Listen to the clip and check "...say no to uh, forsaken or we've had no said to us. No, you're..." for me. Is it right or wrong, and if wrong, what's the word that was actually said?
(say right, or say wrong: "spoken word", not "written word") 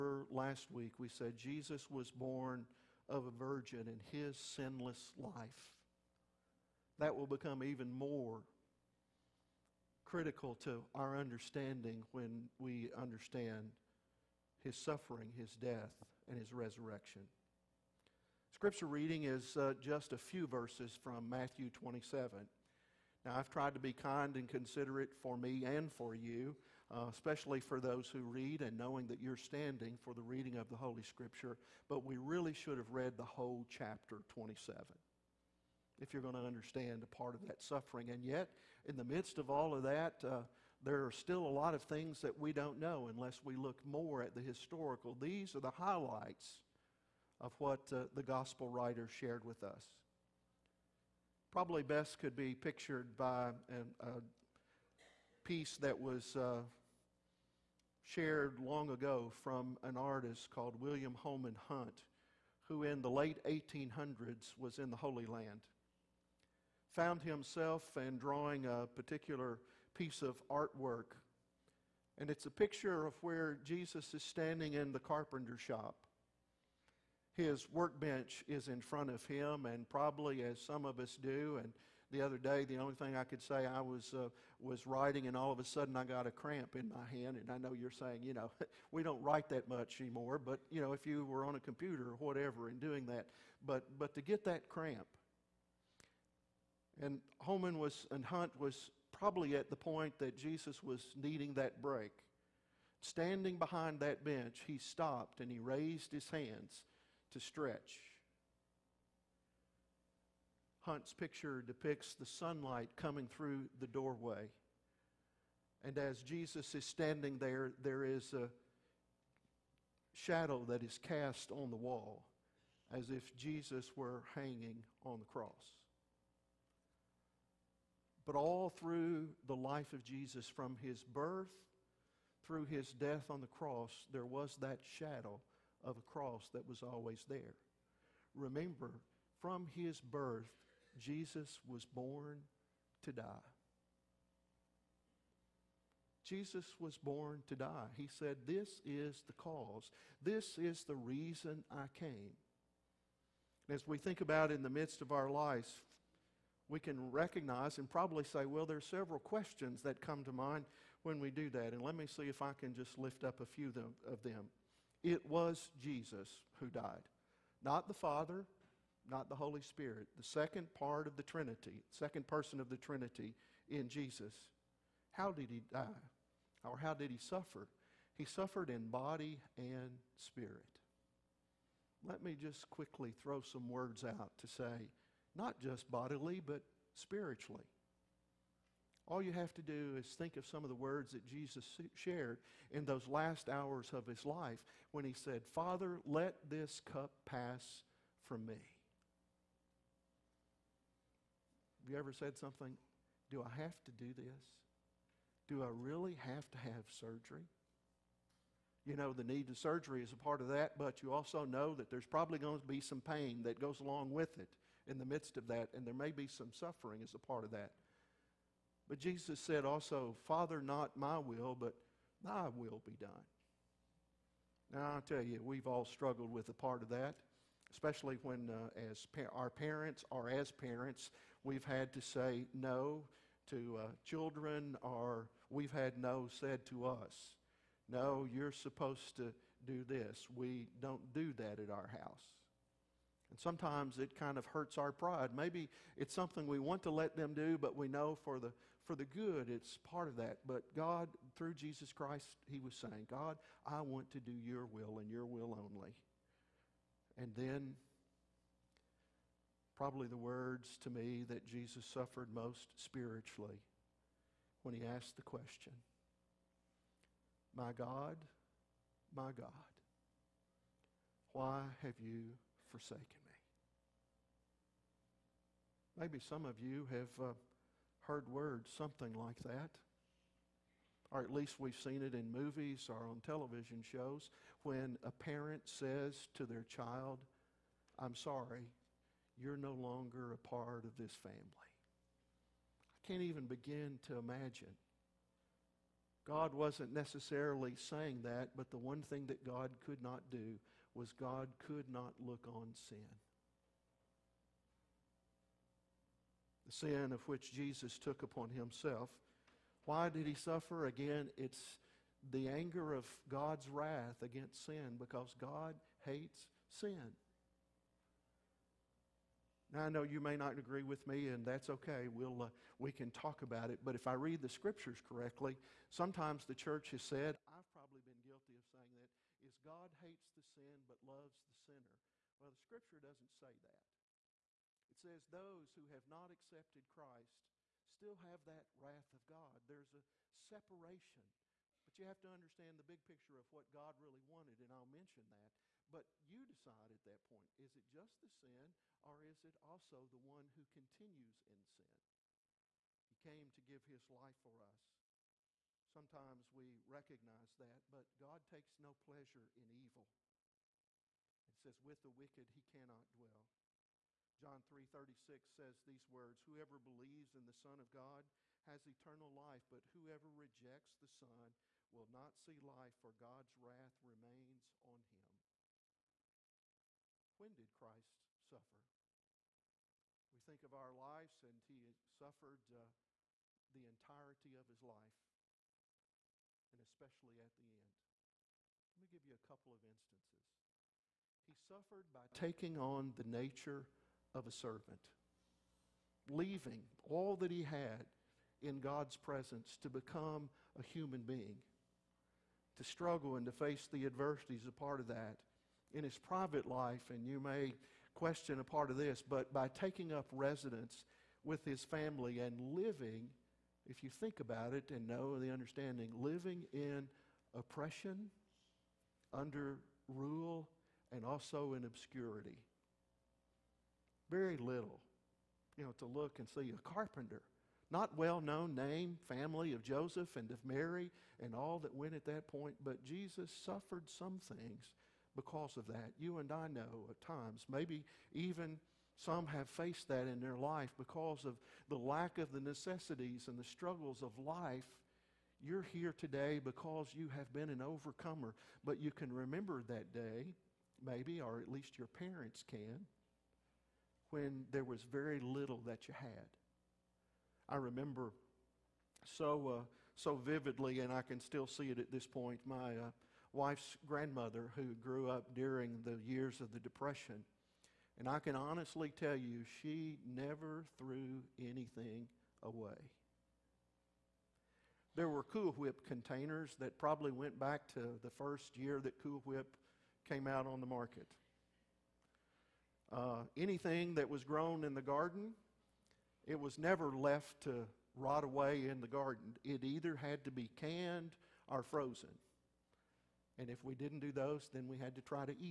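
wrong: "children", not "forsaken".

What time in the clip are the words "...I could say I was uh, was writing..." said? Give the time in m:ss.
1:23.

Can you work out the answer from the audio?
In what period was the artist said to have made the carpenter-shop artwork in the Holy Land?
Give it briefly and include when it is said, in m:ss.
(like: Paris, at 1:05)
late 1800s, at 1:03.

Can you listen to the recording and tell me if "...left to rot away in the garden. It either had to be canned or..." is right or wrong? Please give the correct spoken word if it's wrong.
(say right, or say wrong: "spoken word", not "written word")
right.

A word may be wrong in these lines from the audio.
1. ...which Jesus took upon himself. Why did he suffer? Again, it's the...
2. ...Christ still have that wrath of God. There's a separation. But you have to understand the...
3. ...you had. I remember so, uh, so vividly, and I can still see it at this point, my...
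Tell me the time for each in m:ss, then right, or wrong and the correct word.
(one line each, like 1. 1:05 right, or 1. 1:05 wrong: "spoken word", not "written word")
1. 5:07 right
2. 5:36 right
3. 7:36 right.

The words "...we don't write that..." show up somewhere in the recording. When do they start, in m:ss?
1:28.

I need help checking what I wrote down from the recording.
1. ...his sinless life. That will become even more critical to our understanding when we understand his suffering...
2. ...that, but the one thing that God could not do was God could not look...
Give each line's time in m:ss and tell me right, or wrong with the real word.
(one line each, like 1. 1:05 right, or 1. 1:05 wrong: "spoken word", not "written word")
1. 0:04 right
2. 4:58 right.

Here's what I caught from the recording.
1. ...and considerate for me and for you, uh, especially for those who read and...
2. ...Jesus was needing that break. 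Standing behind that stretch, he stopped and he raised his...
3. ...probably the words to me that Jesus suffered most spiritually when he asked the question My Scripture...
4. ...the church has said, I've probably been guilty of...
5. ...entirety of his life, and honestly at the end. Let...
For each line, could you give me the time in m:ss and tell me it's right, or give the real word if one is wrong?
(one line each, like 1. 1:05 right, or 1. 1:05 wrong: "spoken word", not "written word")
1. 0:24 right
2. 1:40 wrong: "bench", not "stretch"
3. 4:19 wrong: "God", not "Scripture"
4. 5:26 right
5. 6:23 wrong: "especially", not "honestly".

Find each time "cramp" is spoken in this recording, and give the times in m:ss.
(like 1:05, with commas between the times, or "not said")
1:26, 1:34.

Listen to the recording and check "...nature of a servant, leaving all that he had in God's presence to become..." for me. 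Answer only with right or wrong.
right.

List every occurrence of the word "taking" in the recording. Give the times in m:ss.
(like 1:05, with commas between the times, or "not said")
6:32, 6:49.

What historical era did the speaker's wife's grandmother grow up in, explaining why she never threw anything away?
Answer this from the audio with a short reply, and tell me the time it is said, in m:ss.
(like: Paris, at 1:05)
the Depression, at 7:46.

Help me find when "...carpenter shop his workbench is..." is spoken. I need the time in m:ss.
1:14.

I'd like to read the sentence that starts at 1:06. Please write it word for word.
Found himself and drawing a particular piece of artwork.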